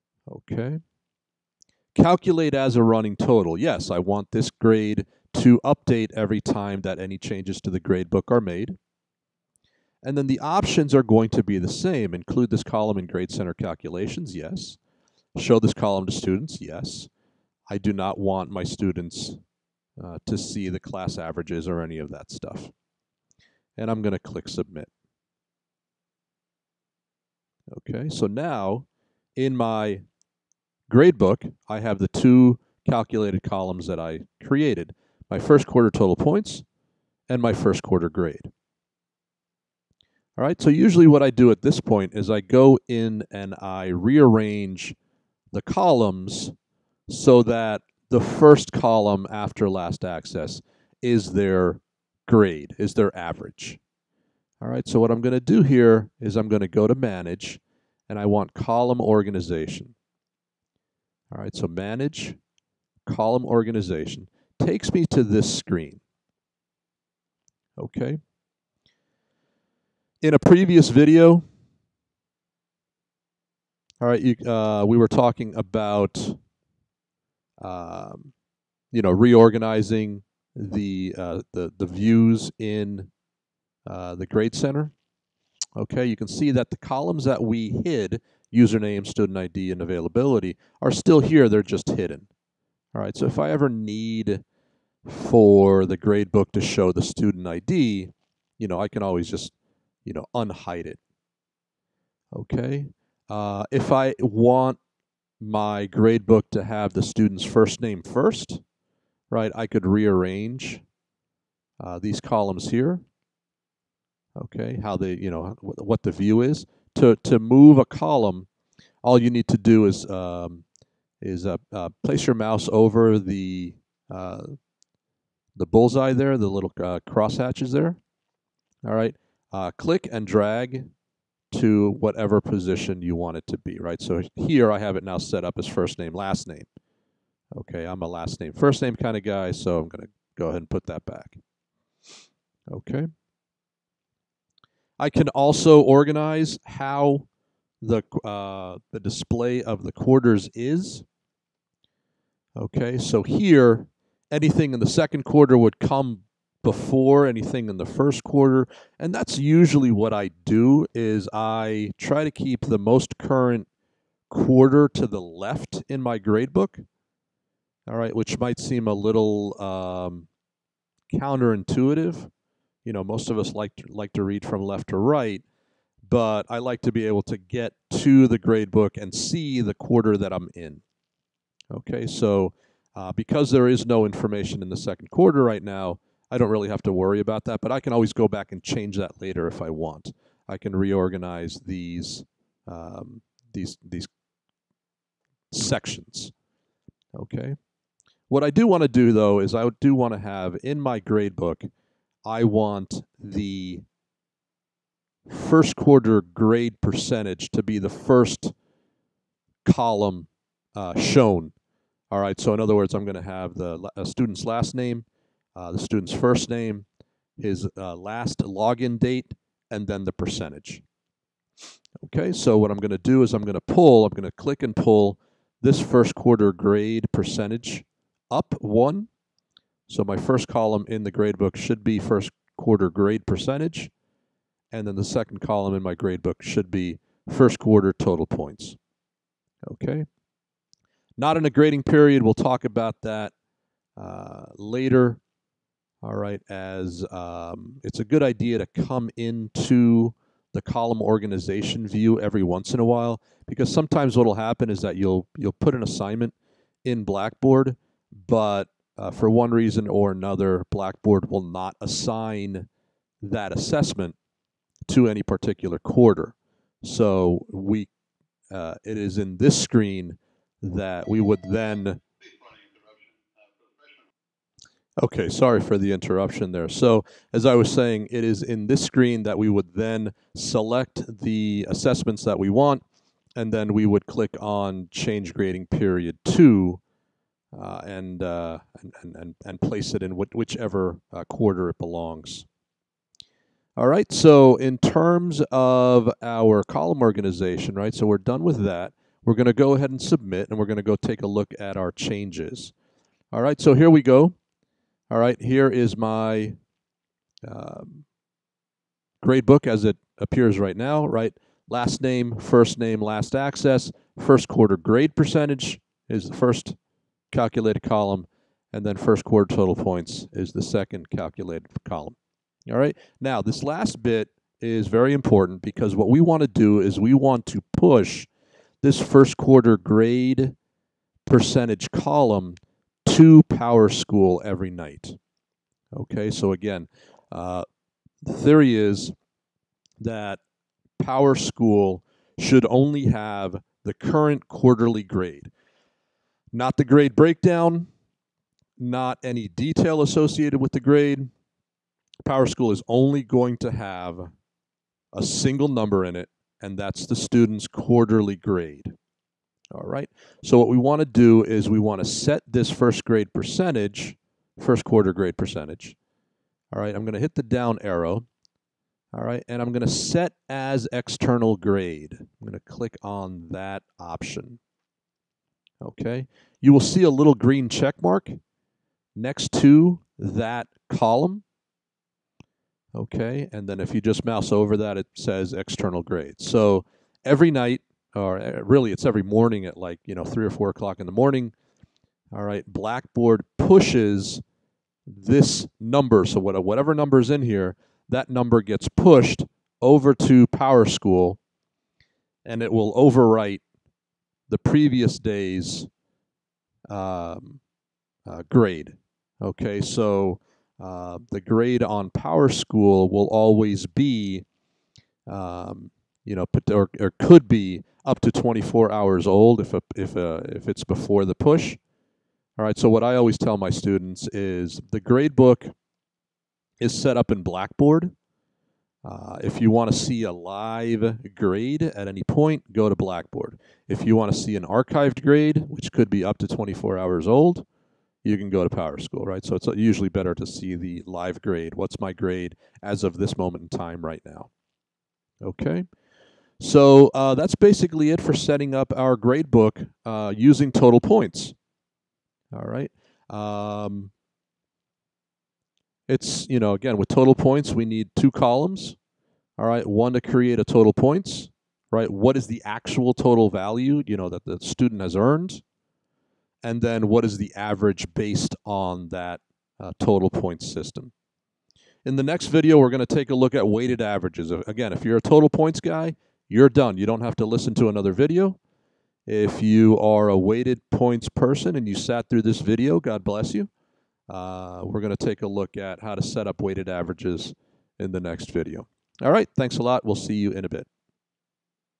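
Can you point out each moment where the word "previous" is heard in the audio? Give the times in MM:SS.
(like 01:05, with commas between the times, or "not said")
01:10, 06:44.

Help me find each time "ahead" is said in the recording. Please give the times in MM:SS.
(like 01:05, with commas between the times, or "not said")
02:20, 04:59.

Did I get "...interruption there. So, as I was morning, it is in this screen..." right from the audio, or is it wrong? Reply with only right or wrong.
wrong.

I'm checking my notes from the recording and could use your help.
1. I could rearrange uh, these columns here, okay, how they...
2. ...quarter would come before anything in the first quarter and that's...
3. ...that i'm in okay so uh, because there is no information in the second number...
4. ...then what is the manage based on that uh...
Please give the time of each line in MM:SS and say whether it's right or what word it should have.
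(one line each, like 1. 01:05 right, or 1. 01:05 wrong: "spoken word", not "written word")
1. 01:49 right
2. 02:35 right
3. 03:00 wrong: "quarter", not "number"
4. 07:46 wrong: "average", not "manage".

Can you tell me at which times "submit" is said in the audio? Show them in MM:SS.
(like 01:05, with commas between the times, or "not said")
00:24, 04:59.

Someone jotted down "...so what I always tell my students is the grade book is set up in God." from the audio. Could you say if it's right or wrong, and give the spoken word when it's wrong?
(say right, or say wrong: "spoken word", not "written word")
wrong: "Blackboard", not "God".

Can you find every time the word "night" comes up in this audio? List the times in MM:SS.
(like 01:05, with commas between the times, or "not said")
05:34, 06:27.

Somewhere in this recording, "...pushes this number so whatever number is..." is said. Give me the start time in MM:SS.
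06:33.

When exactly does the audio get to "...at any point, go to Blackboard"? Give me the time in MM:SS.
07:11.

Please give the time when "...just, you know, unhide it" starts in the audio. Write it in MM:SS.
01:39.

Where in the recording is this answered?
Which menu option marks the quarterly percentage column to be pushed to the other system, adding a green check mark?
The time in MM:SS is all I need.
06:09.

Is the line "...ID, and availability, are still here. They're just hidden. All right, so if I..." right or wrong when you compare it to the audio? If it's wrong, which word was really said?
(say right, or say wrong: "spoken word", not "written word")
right.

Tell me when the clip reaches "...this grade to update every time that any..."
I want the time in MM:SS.
00:04.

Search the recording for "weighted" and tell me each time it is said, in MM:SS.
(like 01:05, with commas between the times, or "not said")
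07:53, 08:00, 08:06.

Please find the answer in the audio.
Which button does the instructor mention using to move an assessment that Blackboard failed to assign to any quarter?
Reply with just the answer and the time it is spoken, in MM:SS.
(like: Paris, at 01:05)
Change Grading Period, at 04:44.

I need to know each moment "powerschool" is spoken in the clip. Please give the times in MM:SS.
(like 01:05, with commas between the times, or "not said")
05:33, 05:41, 05:52, 06:40, 06:52, 07:18.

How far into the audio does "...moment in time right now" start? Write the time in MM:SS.
07:23.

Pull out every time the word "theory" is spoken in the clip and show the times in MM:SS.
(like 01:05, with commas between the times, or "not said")
05:38.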